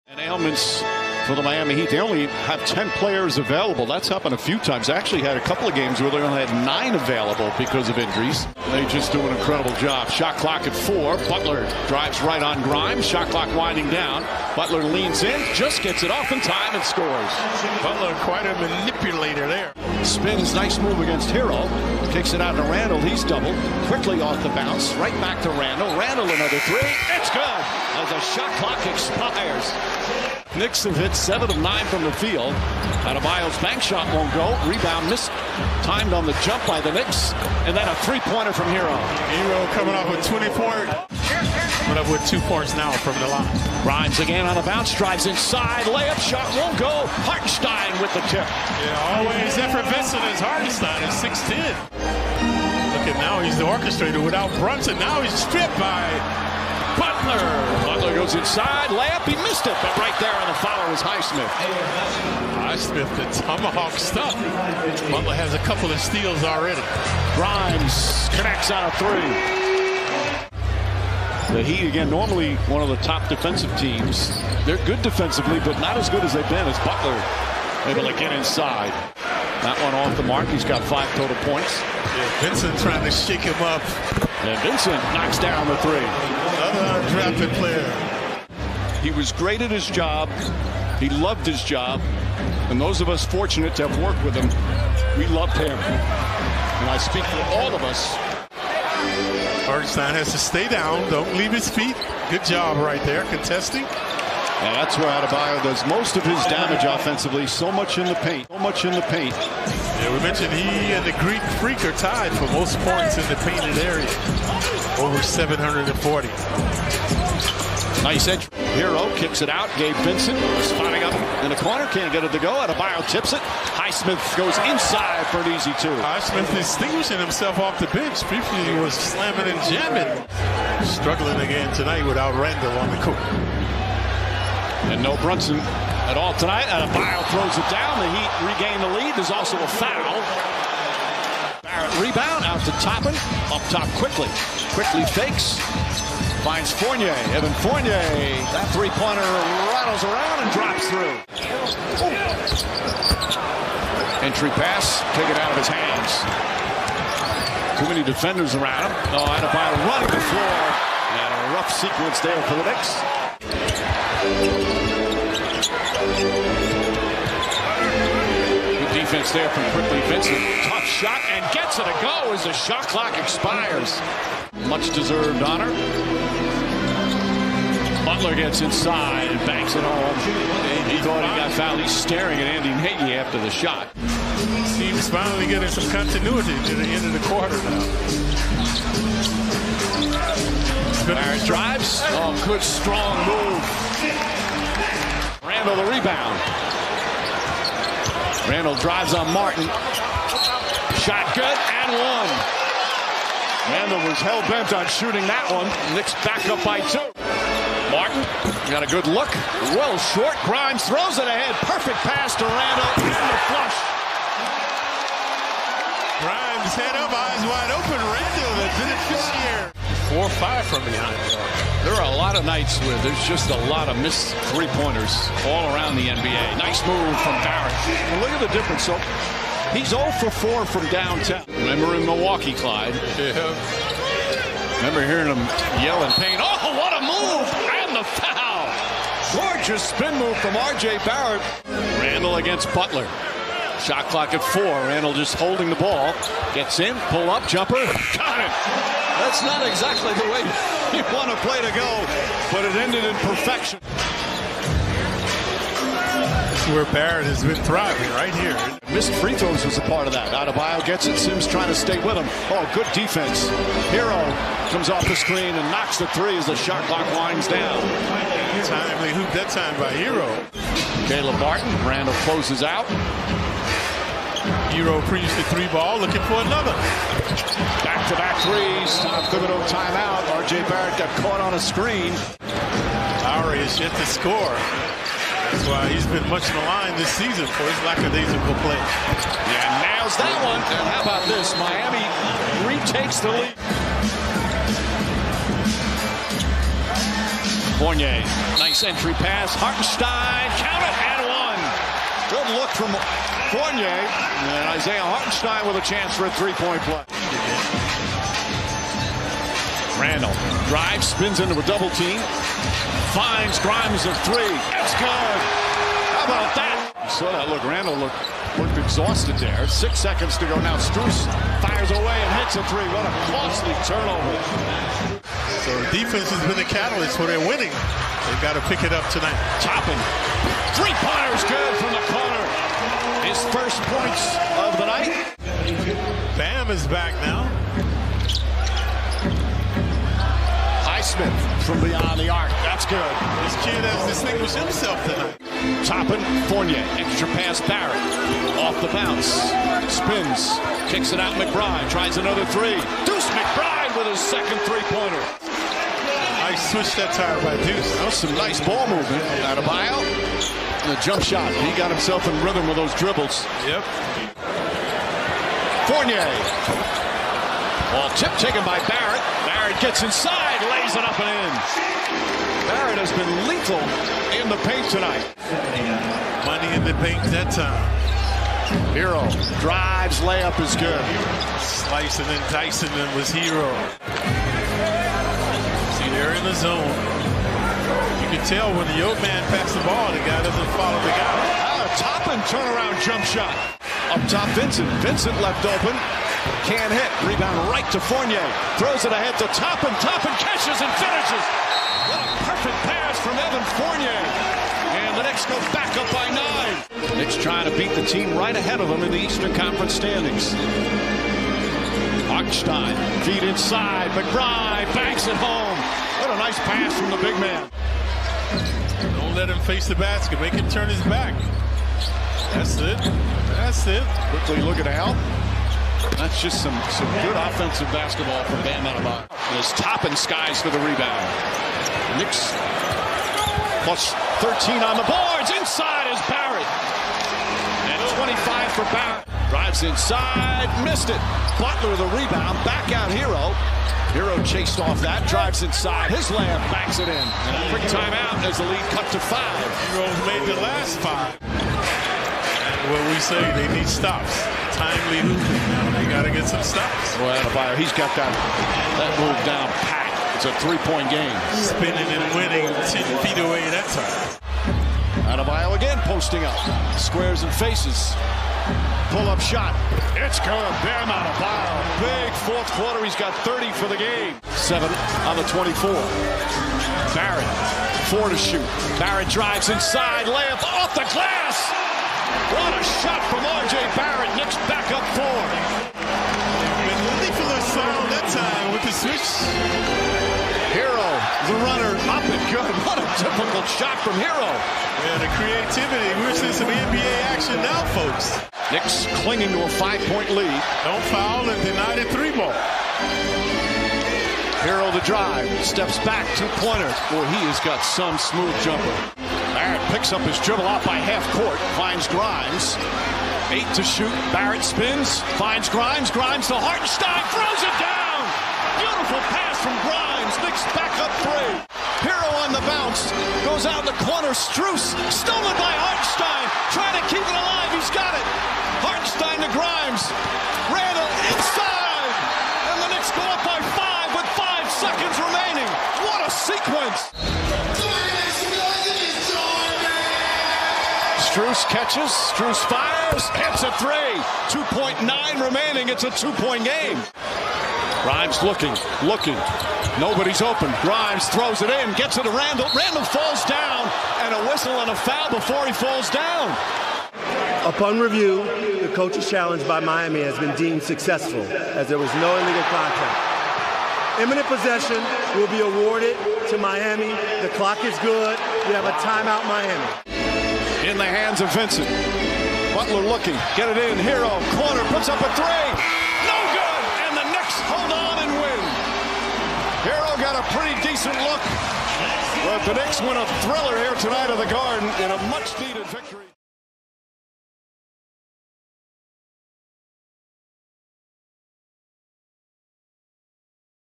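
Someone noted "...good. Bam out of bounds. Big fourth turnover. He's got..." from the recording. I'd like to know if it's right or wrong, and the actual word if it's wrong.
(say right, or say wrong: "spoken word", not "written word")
wrong: "quarter", not "turnover".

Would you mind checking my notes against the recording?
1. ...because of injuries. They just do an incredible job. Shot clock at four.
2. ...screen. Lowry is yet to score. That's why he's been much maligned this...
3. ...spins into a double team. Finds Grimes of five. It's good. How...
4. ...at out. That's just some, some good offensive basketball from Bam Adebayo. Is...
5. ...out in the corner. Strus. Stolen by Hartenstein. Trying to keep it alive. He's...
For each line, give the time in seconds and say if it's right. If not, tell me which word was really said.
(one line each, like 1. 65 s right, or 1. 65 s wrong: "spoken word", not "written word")
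1. 7 s right
2. 281 s right
3. 311 s wrong: "three", not "five"
4. 424 s right
5. 523 s right.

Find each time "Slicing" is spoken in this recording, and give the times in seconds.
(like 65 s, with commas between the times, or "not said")
381 s.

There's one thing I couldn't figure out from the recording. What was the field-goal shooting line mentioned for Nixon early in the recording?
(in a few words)
7 of 9.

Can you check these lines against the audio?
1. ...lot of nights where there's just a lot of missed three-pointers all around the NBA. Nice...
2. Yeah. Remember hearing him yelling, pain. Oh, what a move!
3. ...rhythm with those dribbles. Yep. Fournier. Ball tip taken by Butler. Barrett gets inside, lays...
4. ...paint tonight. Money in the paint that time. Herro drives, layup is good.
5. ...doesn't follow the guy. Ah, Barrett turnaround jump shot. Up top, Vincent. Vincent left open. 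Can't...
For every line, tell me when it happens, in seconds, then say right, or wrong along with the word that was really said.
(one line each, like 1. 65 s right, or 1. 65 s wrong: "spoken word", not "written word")
1. 222 s right
2. 233 s right
3. 362 s wrong: "Barrett", not "Butler"
4. 374 s right
5. 390 s wrong: "Toppin", not "Barrett".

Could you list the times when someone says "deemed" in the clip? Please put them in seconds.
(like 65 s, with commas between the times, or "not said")
560 s.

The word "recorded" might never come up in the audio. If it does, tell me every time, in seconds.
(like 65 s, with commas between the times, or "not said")
not said.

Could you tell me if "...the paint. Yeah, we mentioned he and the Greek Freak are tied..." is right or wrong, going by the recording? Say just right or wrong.
right.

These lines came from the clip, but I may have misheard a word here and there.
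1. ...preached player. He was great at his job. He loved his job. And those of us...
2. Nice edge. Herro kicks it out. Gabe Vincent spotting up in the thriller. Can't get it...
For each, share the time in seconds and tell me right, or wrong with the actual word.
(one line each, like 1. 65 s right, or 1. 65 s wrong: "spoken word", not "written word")
1. 87 s wrong: "drafted", not "preached"
2. 118 s wrong: "corner", not "thriller".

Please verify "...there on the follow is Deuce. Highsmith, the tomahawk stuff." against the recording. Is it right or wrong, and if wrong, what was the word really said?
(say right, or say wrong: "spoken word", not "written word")
wrong: "Highsmith", not "Deuce".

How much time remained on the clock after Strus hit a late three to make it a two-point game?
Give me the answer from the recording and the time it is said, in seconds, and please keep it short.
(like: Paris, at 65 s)
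2.9 seconds, at 544 s.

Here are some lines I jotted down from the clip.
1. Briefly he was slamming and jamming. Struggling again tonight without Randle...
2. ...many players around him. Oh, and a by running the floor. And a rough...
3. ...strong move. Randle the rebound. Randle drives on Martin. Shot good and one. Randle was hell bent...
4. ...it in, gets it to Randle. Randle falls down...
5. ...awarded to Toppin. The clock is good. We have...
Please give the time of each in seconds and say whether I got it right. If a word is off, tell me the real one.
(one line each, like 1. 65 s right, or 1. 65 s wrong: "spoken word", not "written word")
1. 128 s right
2. 157 s wrong: "defenders", not "players"
3. 192 s right
4. 551 s right
5. 565 s wrong: "Miami", not "Toppin".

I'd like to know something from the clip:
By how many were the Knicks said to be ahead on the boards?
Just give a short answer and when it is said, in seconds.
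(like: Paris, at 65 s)
13, at 433 s.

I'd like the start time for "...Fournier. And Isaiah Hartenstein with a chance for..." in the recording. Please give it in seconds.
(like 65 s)
303 s.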